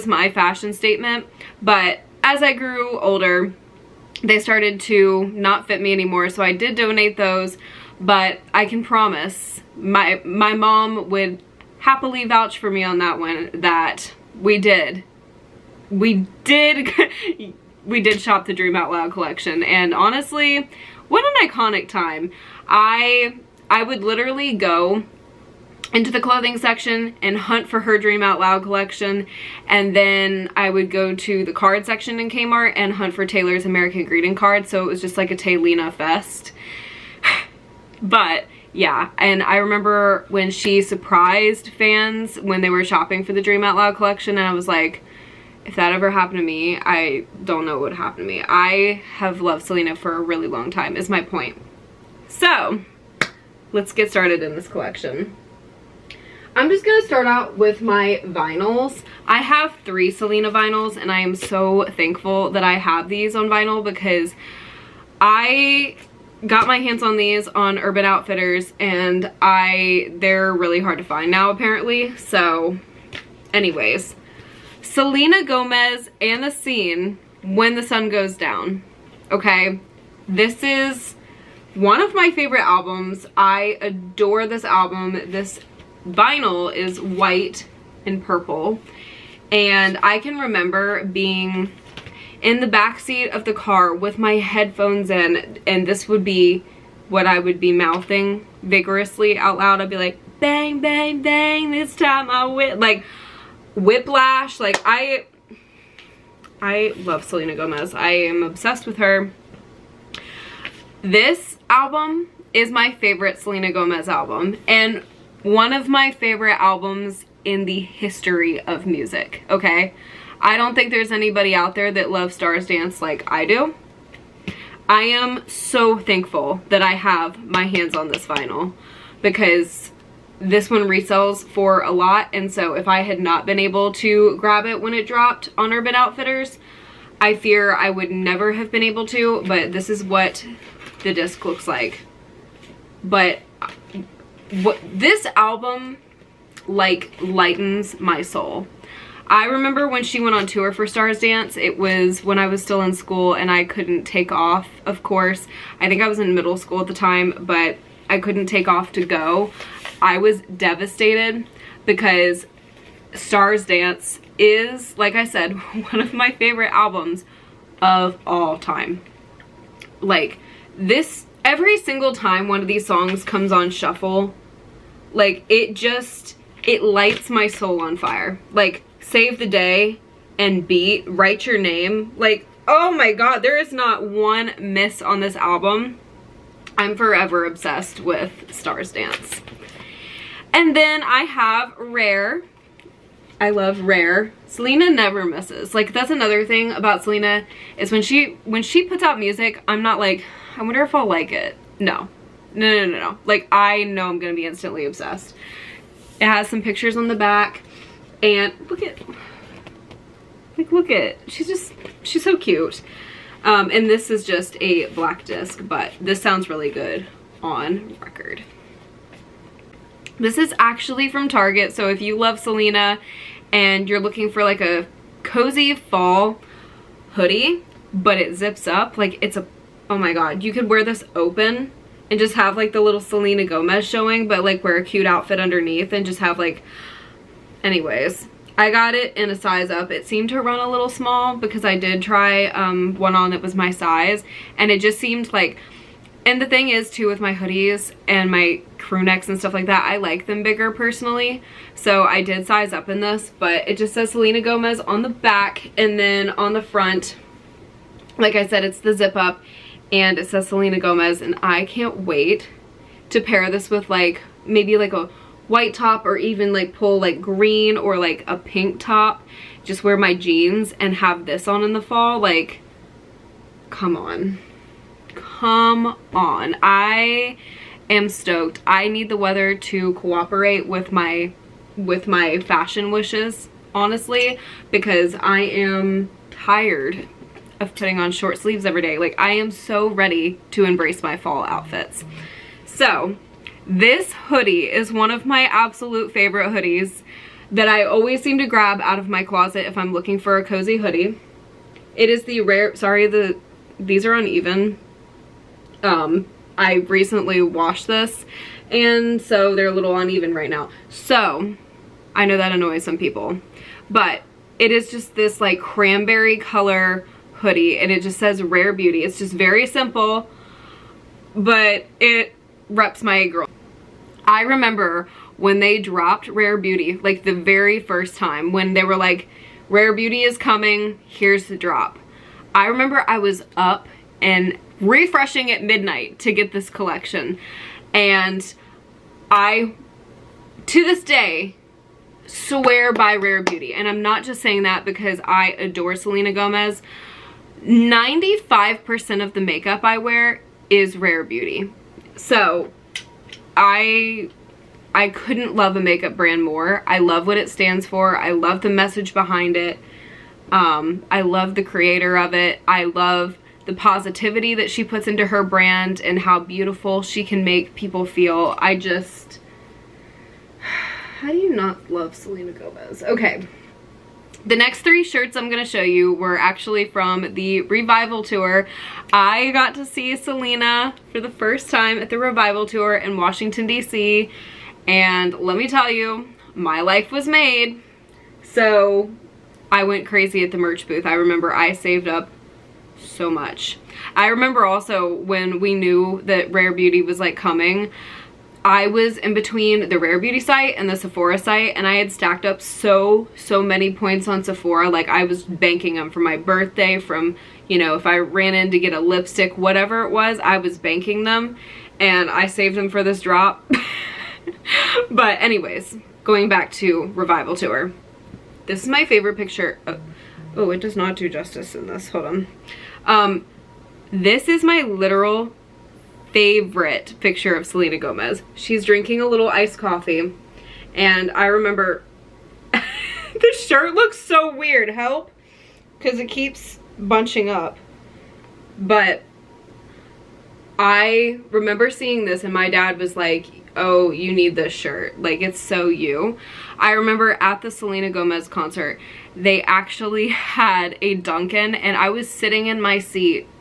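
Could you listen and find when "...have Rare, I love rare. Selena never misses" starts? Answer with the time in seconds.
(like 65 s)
191 s.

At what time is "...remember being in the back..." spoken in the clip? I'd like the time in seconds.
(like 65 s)
90 s.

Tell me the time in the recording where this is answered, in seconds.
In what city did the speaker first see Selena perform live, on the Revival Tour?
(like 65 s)
383 s.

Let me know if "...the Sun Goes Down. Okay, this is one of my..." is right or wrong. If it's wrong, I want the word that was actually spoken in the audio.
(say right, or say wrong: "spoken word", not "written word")
right.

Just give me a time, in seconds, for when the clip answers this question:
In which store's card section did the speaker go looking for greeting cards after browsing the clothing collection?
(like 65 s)
32 s.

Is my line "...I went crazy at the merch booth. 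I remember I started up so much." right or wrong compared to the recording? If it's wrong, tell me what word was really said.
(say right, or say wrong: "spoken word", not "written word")
wrong: "saved", not "started".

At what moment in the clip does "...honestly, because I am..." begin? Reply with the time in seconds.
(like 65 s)
283 s.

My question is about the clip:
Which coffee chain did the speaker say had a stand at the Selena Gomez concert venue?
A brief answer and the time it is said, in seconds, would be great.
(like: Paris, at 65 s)
Dunkin', at 451 s.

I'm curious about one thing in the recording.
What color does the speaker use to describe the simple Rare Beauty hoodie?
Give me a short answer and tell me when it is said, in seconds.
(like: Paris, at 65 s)
cranberry, at 315 s.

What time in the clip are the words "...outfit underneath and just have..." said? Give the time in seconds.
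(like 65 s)
235 s.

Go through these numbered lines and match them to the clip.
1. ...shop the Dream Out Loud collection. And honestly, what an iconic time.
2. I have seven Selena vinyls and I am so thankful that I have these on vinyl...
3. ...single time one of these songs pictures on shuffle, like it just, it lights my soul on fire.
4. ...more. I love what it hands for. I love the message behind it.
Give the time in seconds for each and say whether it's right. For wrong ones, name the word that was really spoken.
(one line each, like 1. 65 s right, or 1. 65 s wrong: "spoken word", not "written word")
1. 18 s right
2. 59 s wrong: "three", not "seven"
3. 171 s wrong: "comes", not "pictures"
4. 356 s wrong: "stands", not "hands".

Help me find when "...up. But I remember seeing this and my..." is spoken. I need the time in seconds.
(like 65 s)
437 s.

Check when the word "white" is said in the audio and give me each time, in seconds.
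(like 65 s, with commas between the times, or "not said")
87 s, 265 s.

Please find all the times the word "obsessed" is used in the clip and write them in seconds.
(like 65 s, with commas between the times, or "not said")
108 s, 187 s, 204 s.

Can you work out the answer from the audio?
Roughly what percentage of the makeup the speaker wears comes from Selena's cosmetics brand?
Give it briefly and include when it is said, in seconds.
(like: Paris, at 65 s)
95%, at 347 s.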